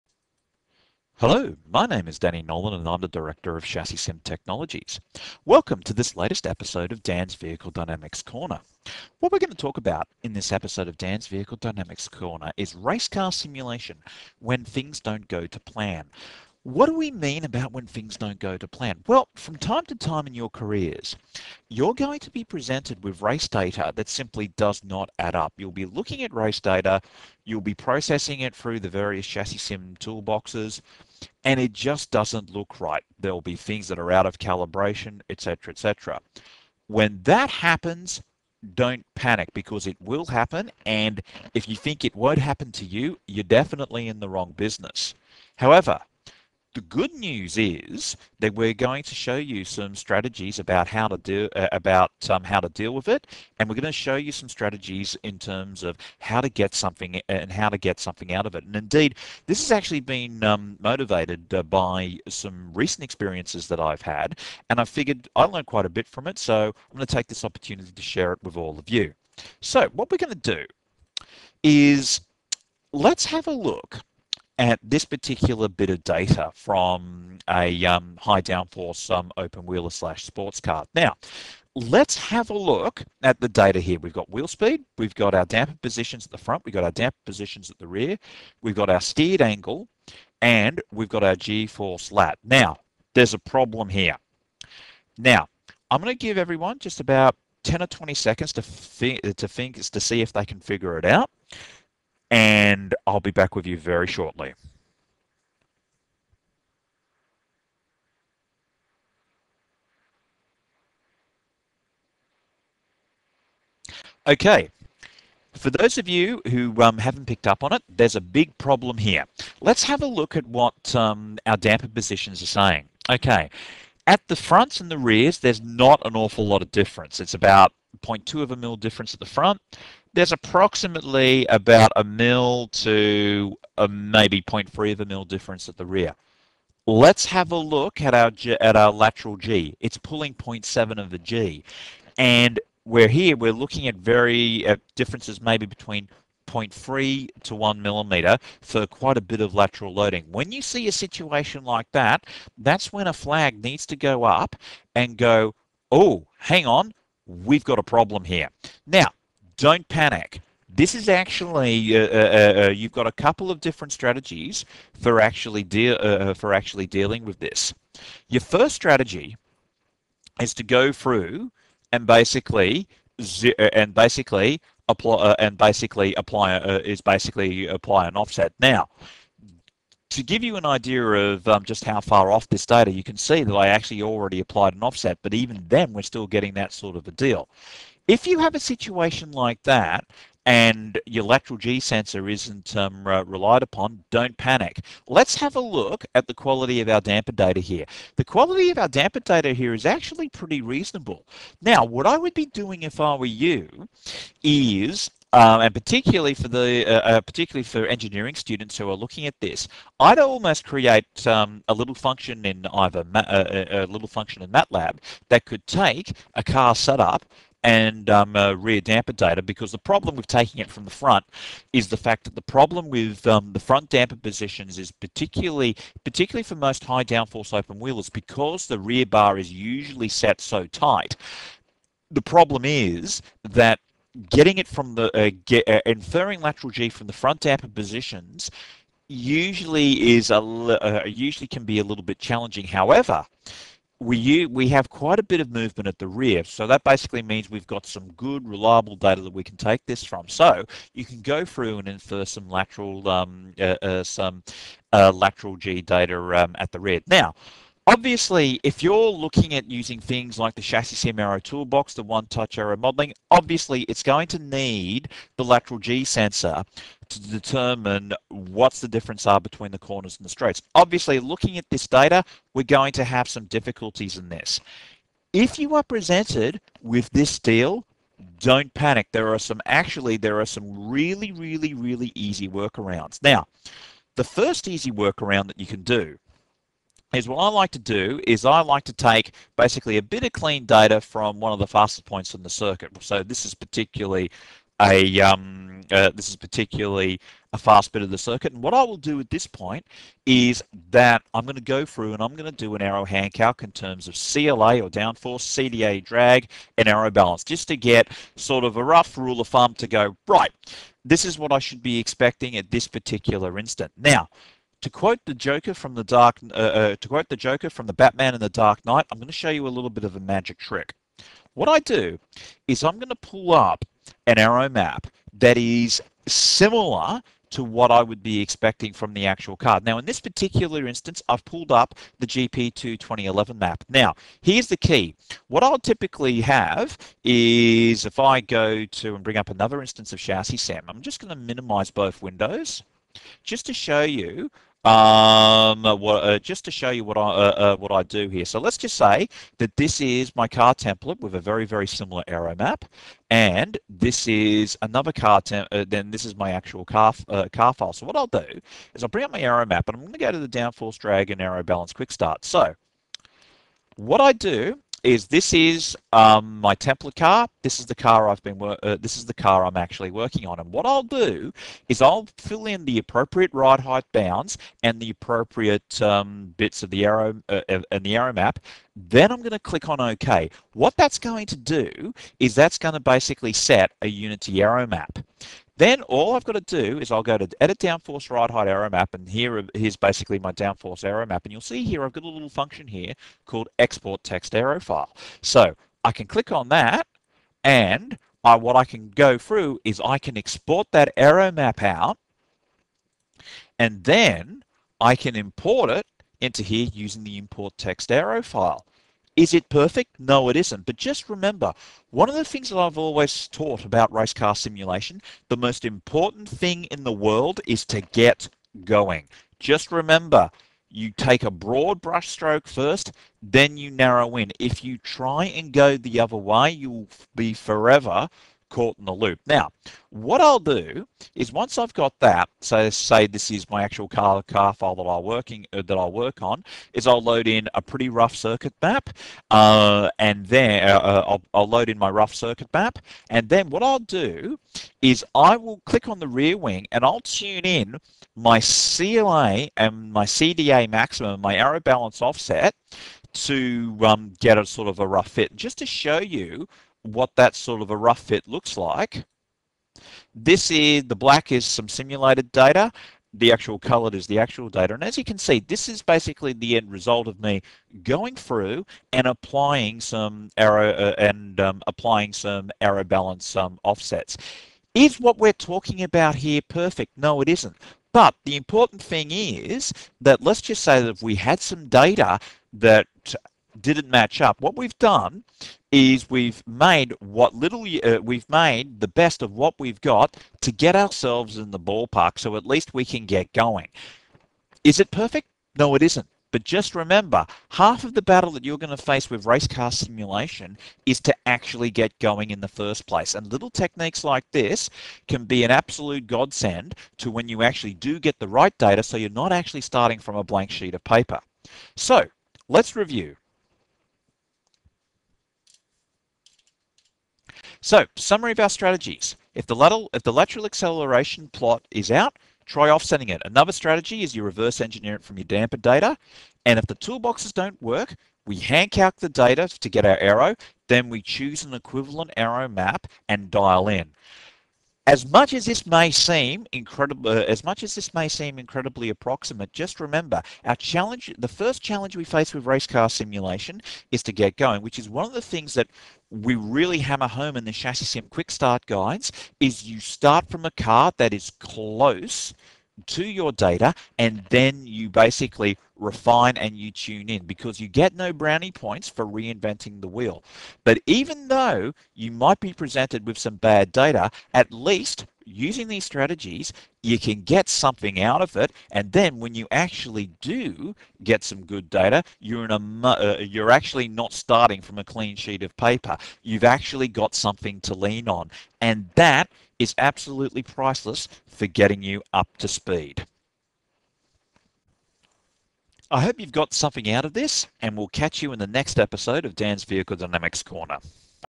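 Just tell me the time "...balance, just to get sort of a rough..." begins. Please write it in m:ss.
5:07.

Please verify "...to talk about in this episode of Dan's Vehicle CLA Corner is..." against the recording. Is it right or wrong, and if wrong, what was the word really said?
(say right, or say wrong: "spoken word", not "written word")
wrong: "Dynamics", not "CLA".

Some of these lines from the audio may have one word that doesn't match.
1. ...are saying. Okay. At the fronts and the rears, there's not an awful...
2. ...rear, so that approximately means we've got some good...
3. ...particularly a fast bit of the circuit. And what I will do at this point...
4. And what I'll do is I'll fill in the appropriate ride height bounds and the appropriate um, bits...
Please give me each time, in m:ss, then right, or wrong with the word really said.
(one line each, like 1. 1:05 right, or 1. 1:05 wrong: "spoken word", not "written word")
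1. 2:02 right
2. 4:06 wrong: "basically", not "approximately"
3. 4:56 right
4. 6:10 right.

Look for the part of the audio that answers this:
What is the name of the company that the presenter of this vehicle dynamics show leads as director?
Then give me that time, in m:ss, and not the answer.
0:03.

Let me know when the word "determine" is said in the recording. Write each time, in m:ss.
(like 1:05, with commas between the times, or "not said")
4:27.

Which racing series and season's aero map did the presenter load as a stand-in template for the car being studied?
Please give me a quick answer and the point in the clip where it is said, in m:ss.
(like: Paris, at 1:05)
GP2 2011, at 5:32.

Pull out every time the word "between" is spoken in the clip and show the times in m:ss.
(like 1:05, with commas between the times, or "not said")
2:25, 4:29.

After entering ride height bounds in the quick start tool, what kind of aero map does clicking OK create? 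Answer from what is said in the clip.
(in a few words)
A unity aero map.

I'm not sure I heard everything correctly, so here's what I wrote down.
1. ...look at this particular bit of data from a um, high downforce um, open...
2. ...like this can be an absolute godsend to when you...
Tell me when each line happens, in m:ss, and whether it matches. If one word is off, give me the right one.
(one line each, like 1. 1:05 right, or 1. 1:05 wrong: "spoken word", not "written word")
1. 1:13 right
2. 8:24 right.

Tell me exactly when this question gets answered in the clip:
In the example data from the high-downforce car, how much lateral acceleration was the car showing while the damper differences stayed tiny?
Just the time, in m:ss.
2:20.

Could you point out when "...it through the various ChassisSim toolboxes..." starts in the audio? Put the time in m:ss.
0:28.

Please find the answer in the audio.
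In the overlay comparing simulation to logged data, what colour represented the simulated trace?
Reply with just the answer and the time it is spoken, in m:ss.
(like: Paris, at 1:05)
Black, at 7:41.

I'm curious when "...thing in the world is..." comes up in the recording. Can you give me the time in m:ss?
6:56.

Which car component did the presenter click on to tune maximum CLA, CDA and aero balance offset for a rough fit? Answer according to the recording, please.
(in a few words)
The rear wing.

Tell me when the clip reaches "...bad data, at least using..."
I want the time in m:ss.
9:23.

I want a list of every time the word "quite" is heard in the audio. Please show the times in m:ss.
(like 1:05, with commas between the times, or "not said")
1:05, 2:28, 4:04.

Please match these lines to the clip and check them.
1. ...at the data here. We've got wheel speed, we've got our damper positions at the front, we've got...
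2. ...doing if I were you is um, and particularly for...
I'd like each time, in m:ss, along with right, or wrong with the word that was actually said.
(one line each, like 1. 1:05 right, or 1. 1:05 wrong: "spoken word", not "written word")
1. 1:23 right
2. 3:22 right.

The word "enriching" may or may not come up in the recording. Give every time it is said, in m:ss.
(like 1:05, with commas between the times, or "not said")
not said.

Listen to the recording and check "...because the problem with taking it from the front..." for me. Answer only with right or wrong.
right.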